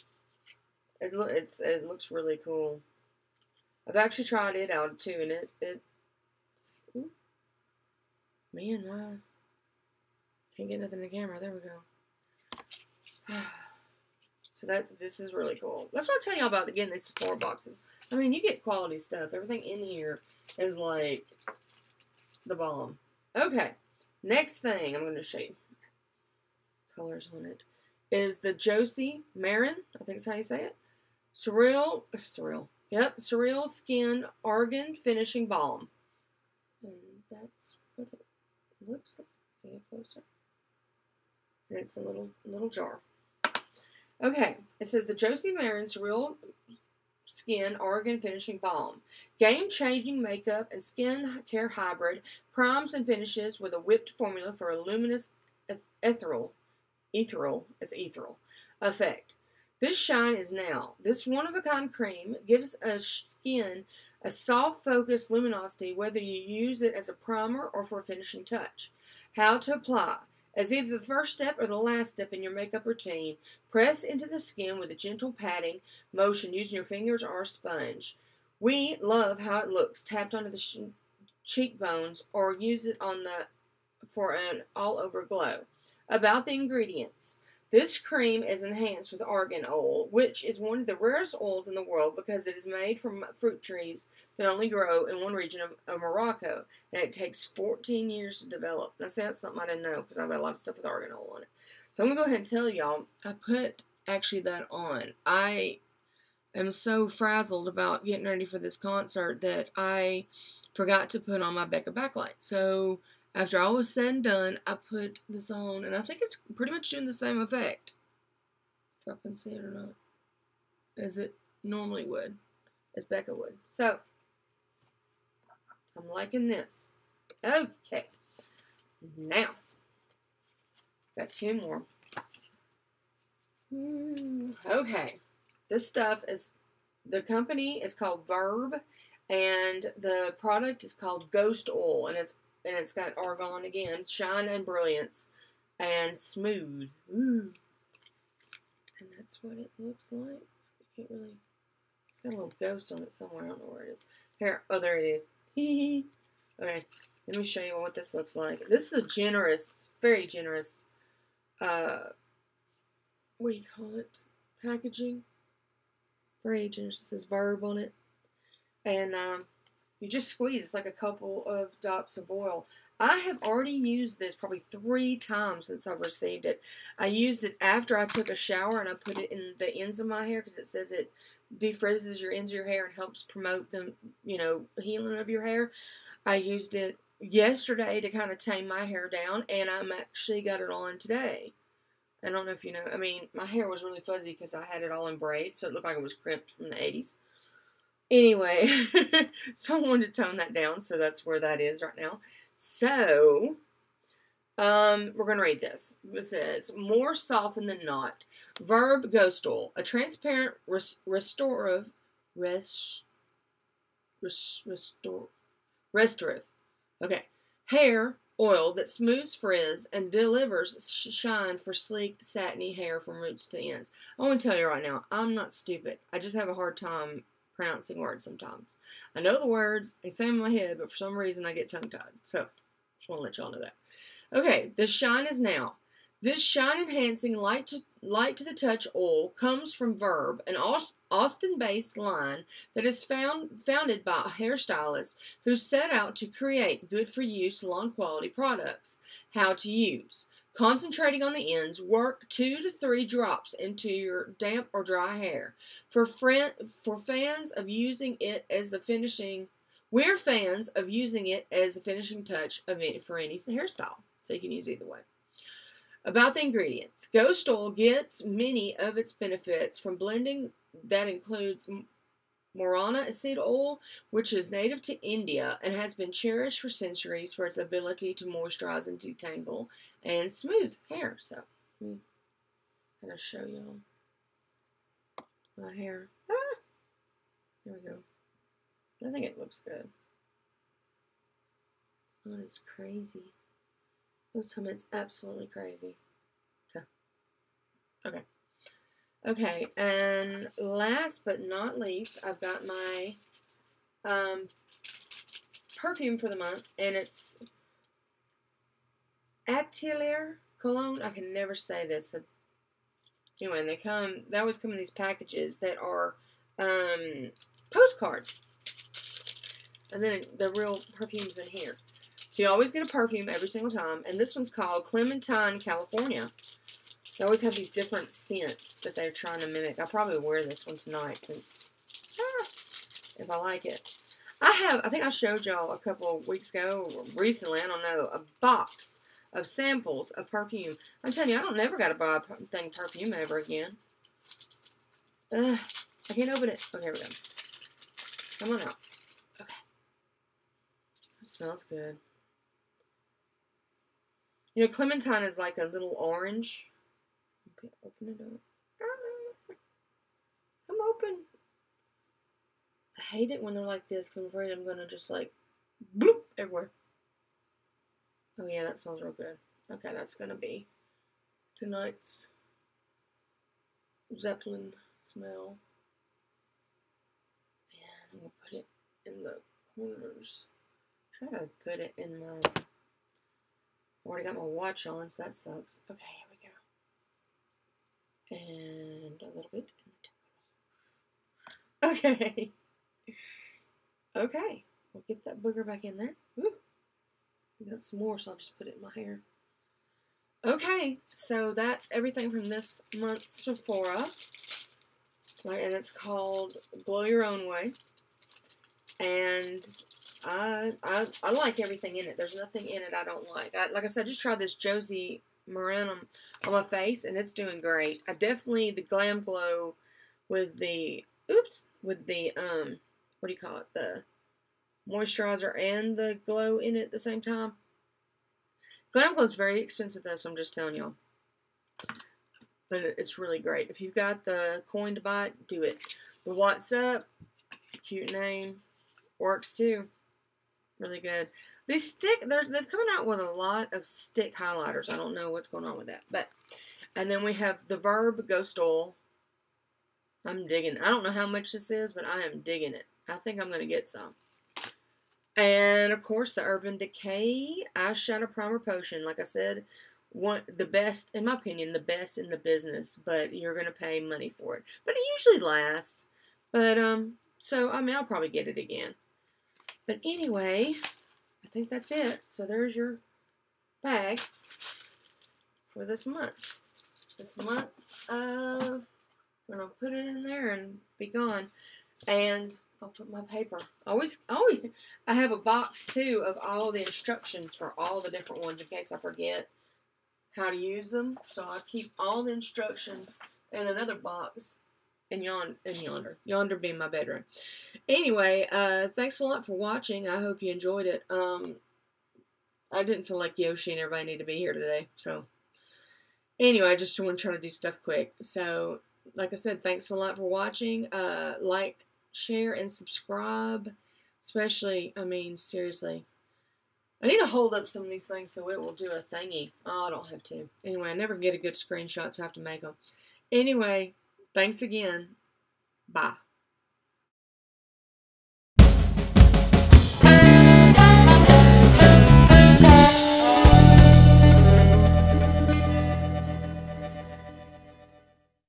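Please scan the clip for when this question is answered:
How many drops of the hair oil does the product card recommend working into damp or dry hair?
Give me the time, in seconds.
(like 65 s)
252 s.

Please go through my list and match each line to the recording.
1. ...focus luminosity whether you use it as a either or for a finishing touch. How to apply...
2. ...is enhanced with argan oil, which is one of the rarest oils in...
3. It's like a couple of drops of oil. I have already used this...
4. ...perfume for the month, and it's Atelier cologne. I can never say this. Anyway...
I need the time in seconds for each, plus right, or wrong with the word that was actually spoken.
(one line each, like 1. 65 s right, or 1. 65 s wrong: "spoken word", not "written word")
1. 64 s wrong: "primer", not "either"
2. 88 s right
3. 170 s right
4. 305 s right.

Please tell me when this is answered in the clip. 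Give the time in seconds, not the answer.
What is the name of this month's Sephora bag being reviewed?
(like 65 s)
406 s.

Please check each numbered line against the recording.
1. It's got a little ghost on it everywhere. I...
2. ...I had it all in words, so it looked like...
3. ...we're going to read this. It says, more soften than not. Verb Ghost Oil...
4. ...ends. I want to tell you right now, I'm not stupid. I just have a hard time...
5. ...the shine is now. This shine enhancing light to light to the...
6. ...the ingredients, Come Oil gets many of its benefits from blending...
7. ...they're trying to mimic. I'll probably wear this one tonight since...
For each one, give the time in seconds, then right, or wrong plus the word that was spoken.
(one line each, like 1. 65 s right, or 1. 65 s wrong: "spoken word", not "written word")
1. 152 s wrong: "somewhere", not "everywhere"
2. 194 s wrong: "braids", not "words"
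3. 205 s right
4. 223 s right
5. 234 s right
6. 266 s wrong: "Ghost", not "Come"
7. 328 s right.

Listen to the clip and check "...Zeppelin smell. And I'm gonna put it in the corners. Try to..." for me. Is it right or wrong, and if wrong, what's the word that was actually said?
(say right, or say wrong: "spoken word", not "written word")
right.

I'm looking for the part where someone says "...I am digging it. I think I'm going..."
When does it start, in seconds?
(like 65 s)
452 s.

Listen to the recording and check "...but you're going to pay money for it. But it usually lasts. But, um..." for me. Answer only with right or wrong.
right.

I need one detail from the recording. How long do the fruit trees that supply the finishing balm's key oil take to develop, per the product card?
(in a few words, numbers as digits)
14 years.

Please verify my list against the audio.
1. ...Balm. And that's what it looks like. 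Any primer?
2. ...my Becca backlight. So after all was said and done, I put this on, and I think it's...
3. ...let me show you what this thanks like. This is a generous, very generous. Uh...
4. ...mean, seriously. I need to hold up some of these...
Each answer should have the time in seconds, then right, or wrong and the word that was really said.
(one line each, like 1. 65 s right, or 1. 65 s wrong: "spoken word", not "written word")
1. 35 s wrong: "closer", not "primer"
2. 111 s right
3. 157 s wrong: "looks", not "thanks"
4. 515 s right.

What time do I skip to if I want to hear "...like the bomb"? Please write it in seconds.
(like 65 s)
20 s.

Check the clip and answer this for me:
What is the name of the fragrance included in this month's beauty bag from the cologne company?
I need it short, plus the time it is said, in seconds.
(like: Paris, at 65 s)
Clementine California, at 324 s.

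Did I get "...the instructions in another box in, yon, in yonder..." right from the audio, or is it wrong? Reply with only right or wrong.
right.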